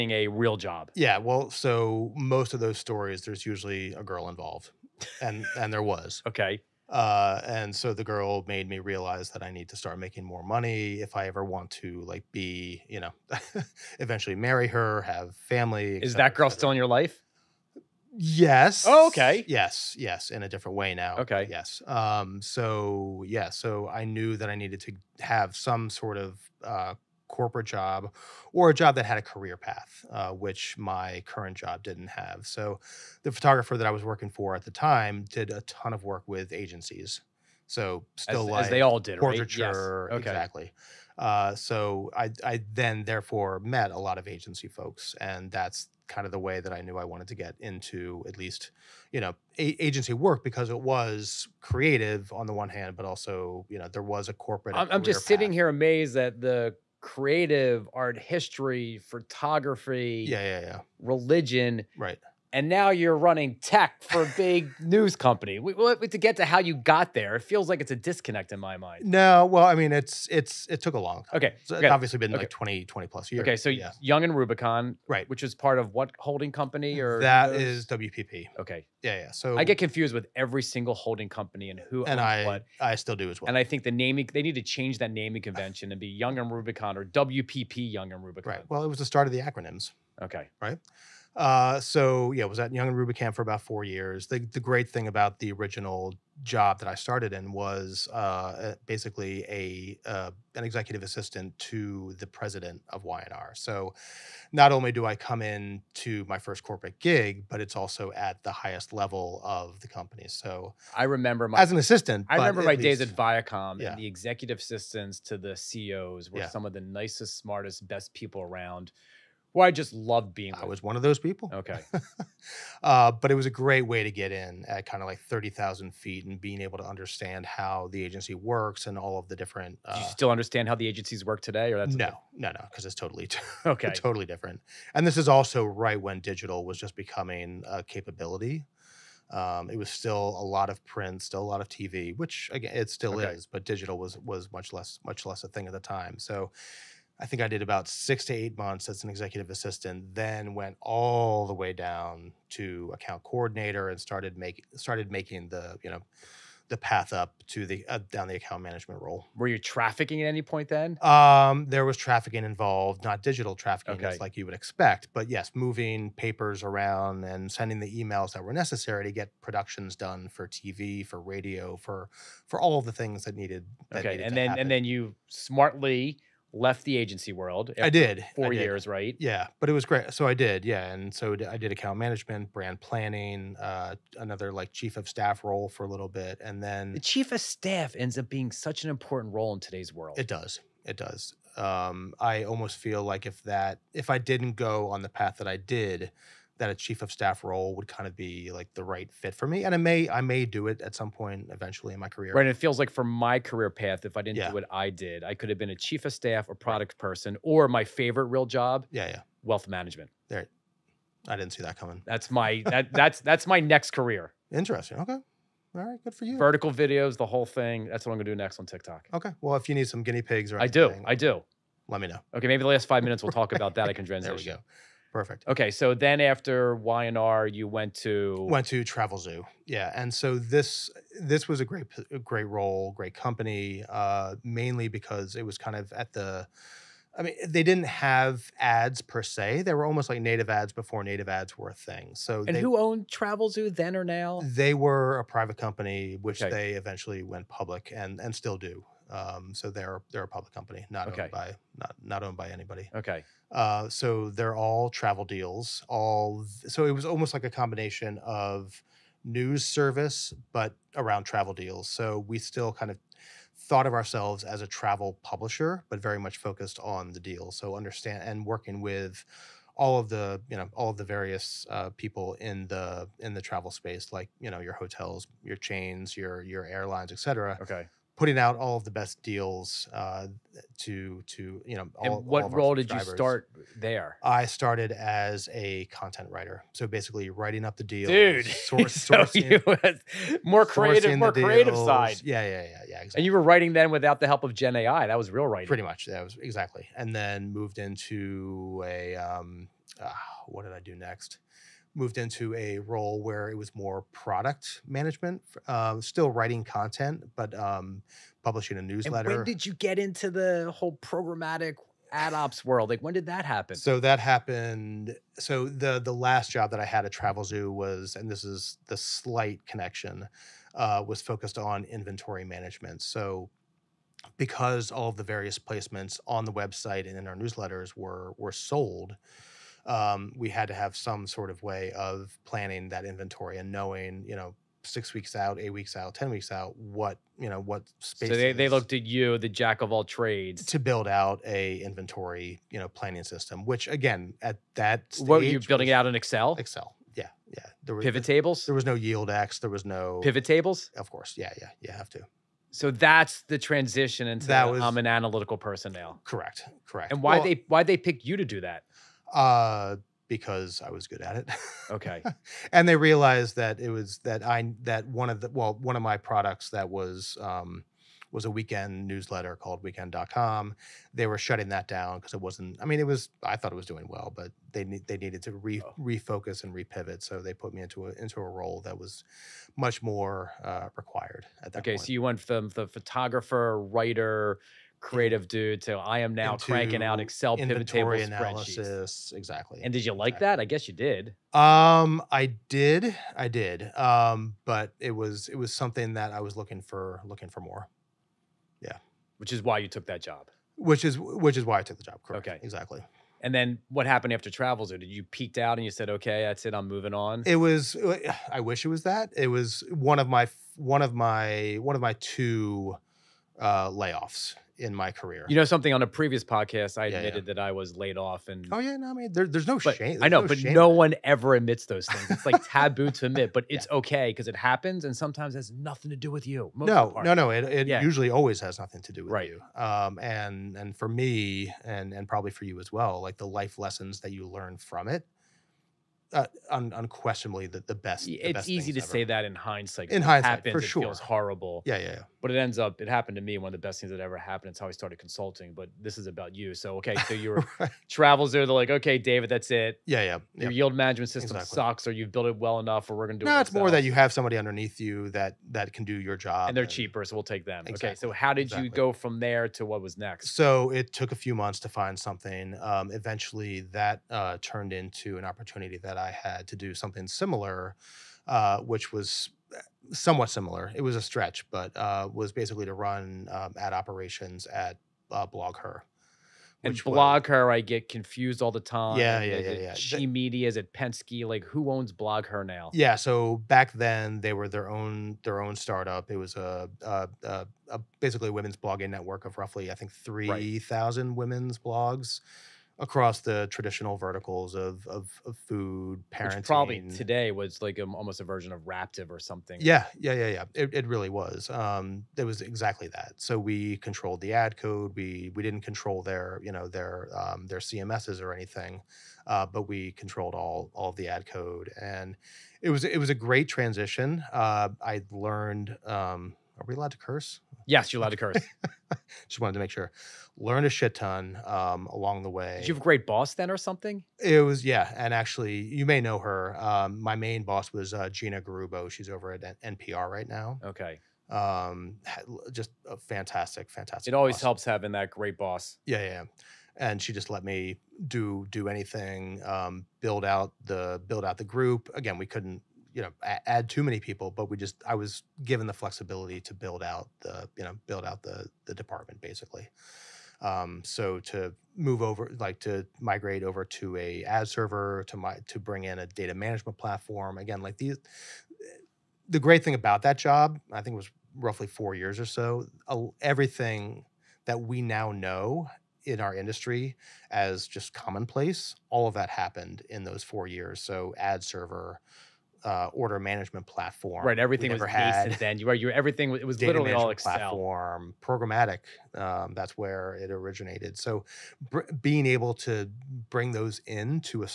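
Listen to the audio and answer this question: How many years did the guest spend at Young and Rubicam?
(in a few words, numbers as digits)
4.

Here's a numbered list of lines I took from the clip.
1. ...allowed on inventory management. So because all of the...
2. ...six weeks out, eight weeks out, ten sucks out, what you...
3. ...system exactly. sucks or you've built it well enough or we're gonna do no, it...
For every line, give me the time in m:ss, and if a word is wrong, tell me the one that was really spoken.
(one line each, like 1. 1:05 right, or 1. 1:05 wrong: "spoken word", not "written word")
1. 5:21 wrong: "focused", not "allowed"
2. 5:34 wrong: "weeks", not "sucks"
3. 7:31 right.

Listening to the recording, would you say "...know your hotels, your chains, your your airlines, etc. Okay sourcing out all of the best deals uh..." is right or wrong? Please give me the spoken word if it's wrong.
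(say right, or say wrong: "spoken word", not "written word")
wrong: "putting", not "sourcing".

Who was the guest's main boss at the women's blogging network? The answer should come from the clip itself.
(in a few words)
Gina Garrubbo.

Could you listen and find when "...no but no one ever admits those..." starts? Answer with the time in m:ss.
7:00.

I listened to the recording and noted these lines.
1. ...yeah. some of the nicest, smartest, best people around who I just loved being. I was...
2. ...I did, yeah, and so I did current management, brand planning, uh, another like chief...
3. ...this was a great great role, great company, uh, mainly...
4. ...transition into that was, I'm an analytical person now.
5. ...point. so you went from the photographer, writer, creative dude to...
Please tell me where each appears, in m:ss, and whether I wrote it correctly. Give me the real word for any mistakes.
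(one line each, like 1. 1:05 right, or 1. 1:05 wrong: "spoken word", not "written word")
1. 1:56 right
2. 3:00 wrong: "account", not "current"
3. 3:51 right
4. 5:53 right
5. 6:21 right.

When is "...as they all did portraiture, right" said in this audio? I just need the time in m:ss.
0:38.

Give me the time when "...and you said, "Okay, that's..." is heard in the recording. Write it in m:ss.
6:45.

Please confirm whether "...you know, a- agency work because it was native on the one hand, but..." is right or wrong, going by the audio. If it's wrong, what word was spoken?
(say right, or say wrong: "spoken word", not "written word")
wrong: "creative", not "native".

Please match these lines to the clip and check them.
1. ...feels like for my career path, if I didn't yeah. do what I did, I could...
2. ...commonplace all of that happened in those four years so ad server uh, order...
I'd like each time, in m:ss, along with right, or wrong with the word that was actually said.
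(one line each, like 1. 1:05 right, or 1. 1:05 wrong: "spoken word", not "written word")
1. 3:22 right
2. 9:28 right.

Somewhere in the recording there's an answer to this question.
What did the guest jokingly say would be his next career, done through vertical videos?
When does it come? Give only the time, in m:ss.
3:29.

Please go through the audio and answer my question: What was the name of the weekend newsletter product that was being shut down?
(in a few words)
weekend.com.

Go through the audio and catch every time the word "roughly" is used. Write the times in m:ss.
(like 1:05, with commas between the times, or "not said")
8:09, 9:21.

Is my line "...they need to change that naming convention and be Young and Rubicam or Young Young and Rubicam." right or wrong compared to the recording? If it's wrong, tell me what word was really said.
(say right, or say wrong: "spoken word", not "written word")
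wrong: "WPP", not "Young".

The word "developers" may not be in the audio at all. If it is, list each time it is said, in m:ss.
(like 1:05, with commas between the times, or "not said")
not said.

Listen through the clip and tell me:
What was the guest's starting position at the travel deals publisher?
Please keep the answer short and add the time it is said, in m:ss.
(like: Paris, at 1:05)
content writer, at 4:45.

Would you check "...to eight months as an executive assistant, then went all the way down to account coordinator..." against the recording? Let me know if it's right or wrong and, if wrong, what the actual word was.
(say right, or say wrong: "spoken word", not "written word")
right.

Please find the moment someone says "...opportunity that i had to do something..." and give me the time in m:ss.
7:45.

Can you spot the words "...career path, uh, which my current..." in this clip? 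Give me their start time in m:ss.
0:29.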